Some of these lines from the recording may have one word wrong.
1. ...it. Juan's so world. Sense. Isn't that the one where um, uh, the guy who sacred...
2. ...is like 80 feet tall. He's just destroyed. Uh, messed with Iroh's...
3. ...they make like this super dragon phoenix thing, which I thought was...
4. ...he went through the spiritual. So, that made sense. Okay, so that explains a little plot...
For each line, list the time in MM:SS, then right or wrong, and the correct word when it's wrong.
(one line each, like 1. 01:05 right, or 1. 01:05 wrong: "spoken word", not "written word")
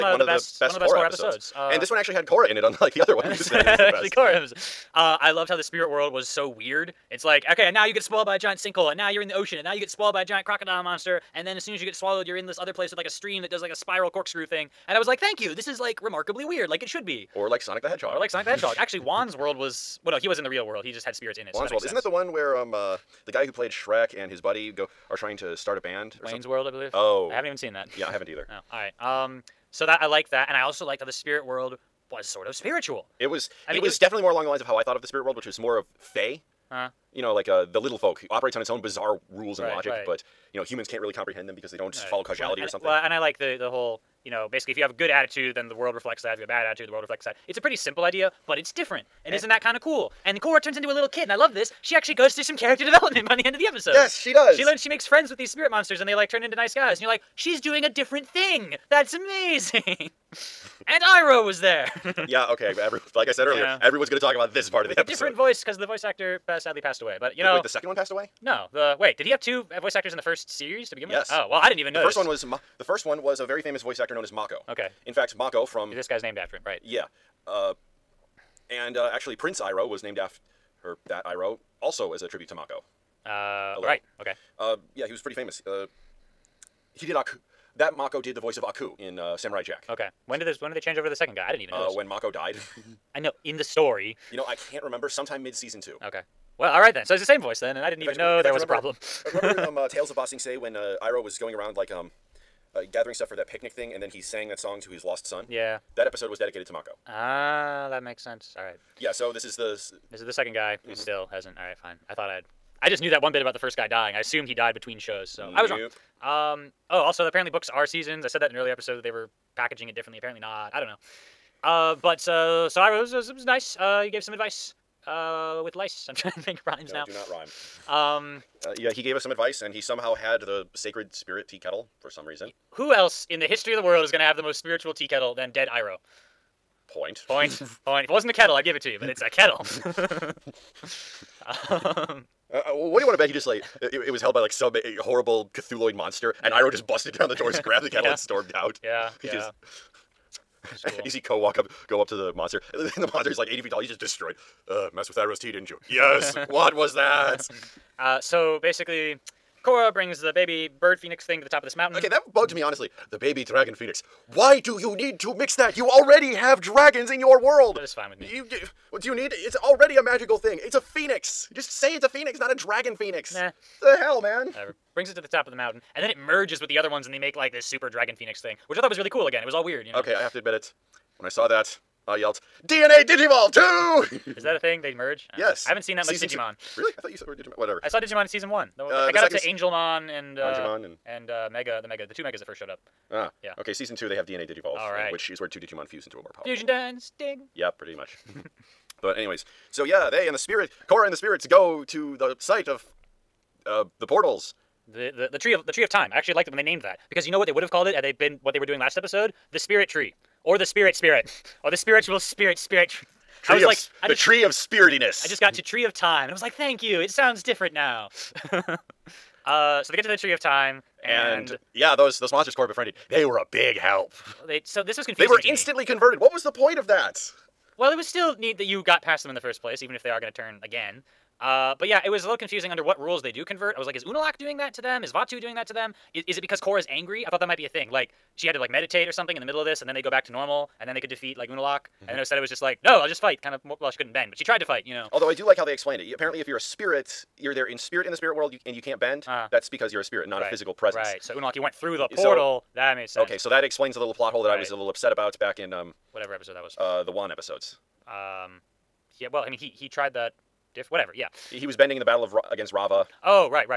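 1. 00:21 wrong: "played", not "sacred"
2. 02:33 right
3. 02:57 right
4. 04:11 wrong: "portal", not "spiritual".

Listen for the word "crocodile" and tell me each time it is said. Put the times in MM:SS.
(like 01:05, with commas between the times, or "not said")
00:10.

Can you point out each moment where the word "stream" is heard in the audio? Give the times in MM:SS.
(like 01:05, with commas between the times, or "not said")
00:13.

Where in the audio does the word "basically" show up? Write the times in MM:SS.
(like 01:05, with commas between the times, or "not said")
00:44, 02:38.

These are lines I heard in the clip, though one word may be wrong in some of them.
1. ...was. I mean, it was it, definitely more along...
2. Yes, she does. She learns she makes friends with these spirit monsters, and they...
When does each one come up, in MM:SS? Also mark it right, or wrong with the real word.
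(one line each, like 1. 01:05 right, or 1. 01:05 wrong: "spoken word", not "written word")
1. 00:33 right
2. 00:53 right.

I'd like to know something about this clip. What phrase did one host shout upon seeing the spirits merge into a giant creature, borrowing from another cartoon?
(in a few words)
DNA Digivolve 2.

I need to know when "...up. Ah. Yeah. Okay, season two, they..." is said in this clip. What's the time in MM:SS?
03:12.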